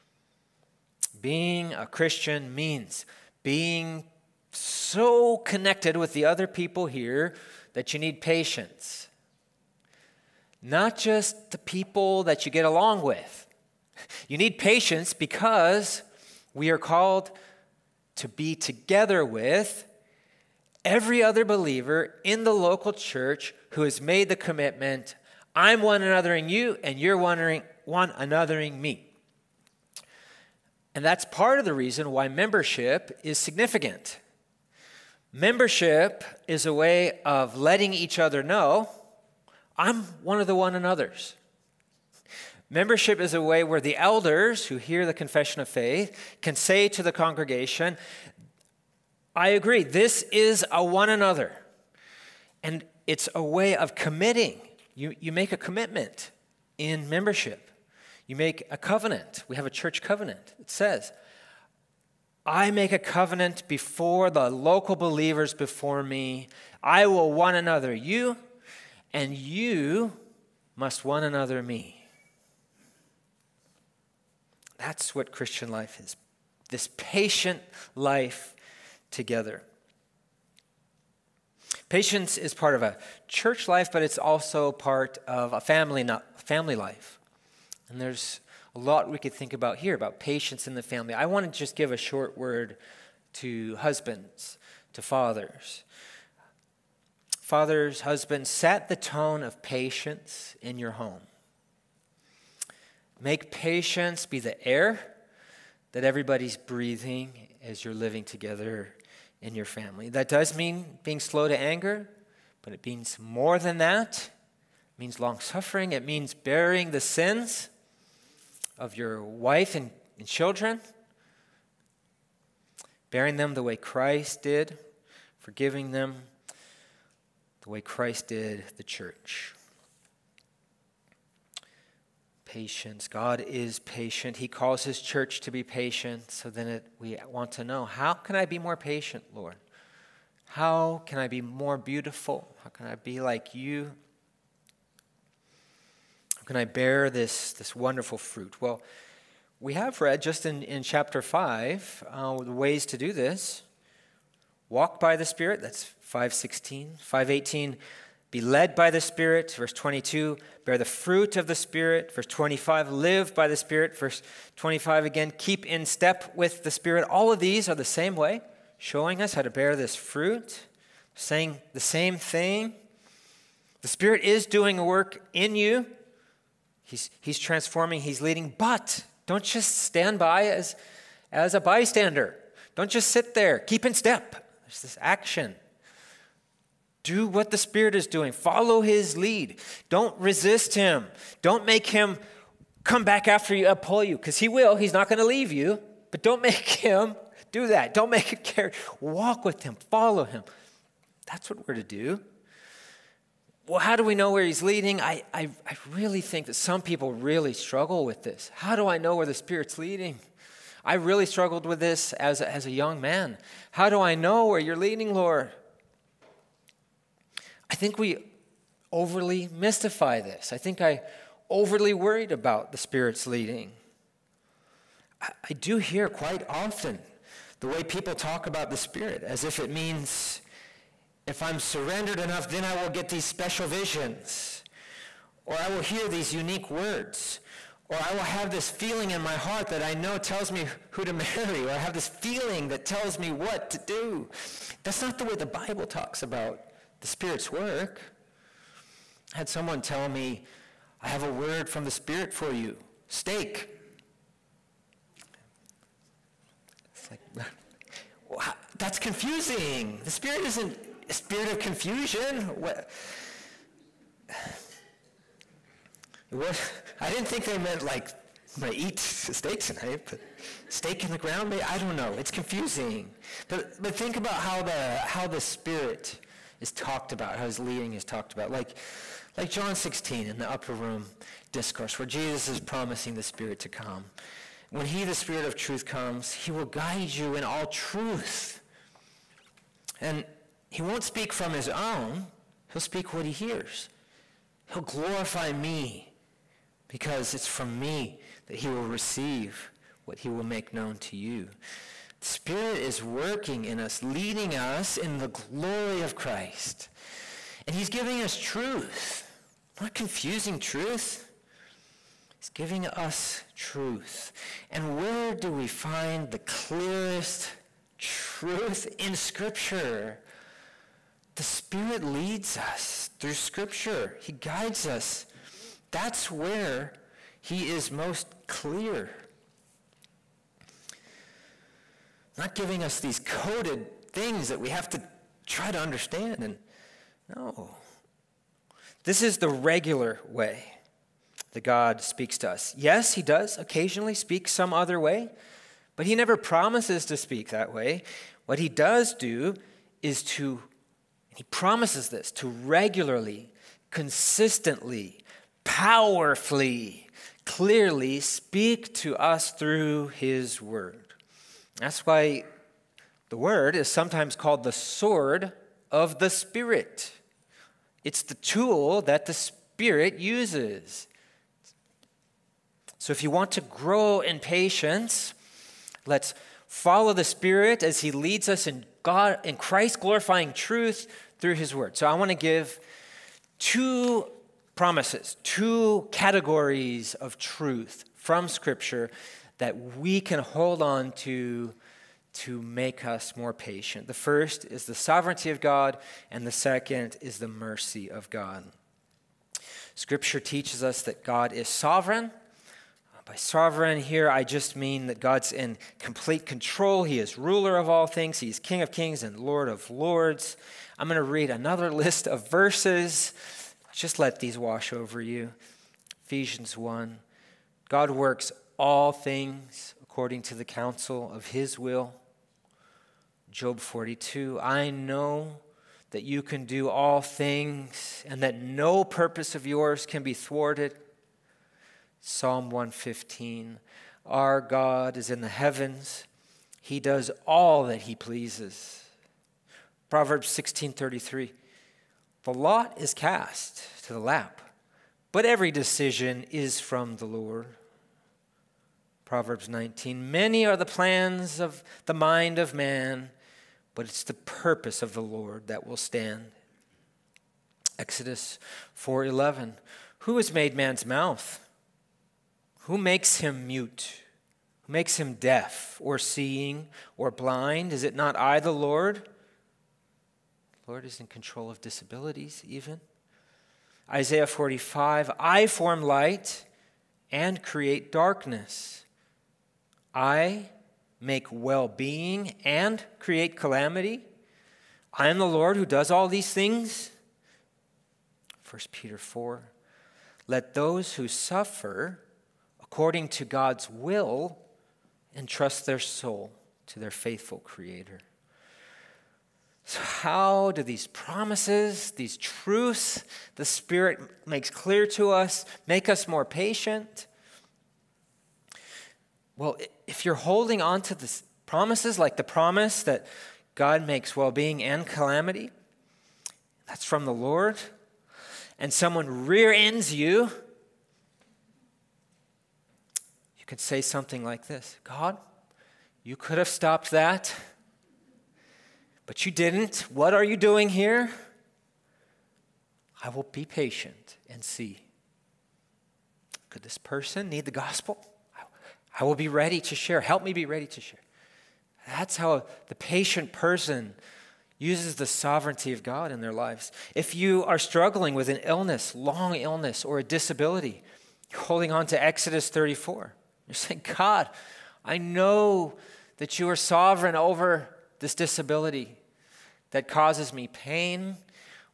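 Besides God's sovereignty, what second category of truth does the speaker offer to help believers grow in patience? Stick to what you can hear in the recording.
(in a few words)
mercy of God.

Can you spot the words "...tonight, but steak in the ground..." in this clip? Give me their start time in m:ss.
4:29.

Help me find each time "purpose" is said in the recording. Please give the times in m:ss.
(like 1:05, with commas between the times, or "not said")
7:09, 7:34.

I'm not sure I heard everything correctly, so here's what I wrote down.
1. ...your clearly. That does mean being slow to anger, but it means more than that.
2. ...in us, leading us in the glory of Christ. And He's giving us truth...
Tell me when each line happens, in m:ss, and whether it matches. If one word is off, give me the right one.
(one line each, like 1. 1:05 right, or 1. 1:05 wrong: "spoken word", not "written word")
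1. 1:49 wrong: "family", not "clearly"
2. 5:03 right.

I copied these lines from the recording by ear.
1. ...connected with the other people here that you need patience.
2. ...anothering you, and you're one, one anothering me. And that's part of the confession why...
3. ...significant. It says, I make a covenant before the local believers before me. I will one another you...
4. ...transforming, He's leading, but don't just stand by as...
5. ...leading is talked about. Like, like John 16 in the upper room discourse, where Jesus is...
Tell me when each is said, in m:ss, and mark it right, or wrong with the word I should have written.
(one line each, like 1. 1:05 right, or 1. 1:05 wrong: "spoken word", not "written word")
1. 0:05 right
2. 0:26 wrong: "reason", not "confession"
3. 1:00 wrong: "covenant", not "significant"
4. 2:57 right
5. 4:37 right.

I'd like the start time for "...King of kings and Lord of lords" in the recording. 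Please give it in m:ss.
6:48.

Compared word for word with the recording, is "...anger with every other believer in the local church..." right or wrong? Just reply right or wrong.
wrong.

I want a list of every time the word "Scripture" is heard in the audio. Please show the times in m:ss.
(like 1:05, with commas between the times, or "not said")
5:19, 5:23, 6:28, 6:39.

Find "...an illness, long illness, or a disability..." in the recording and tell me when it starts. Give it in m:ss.
9:08.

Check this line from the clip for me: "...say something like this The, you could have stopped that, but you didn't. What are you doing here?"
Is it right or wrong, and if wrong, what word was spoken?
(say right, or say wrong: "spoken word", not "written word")
wrong: "God", not "The".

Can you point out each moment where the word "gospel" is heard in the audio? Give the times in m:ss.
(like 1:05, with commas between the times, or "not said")
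8:57.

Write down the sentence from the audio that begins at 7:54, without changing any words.
Isaiah 45 I form light and create darkness.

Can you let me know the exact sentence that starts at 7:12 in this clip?
Psalm 115 Our God is in the heavens, he does all that he pleases.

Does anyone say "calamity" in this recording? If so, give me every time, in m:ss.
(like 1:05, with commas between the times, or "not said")
8:03, 8:35.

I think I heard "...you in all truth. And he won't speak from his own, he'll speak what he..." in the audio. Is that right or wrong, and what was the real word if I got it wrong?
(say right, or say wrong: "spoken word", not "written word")
right.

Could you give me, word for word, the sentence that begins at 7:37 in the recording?
Exodus 4:11 Who has made man's mouth?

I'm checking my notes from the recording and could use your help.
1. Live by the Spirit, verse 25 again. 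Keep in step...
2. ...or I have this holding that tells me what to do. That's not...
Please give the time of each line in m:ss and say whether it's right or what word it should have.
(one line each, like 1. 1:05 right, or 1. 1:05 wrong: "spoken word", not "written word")
1. 2:42 right
2. 4:01 wrong: "feeling", not "holding".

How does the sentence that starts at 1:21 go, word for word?
Patience is part of a church life, but it's also part of a family, not family life.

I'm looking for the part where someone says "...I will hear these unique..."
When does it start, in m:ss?
3:55.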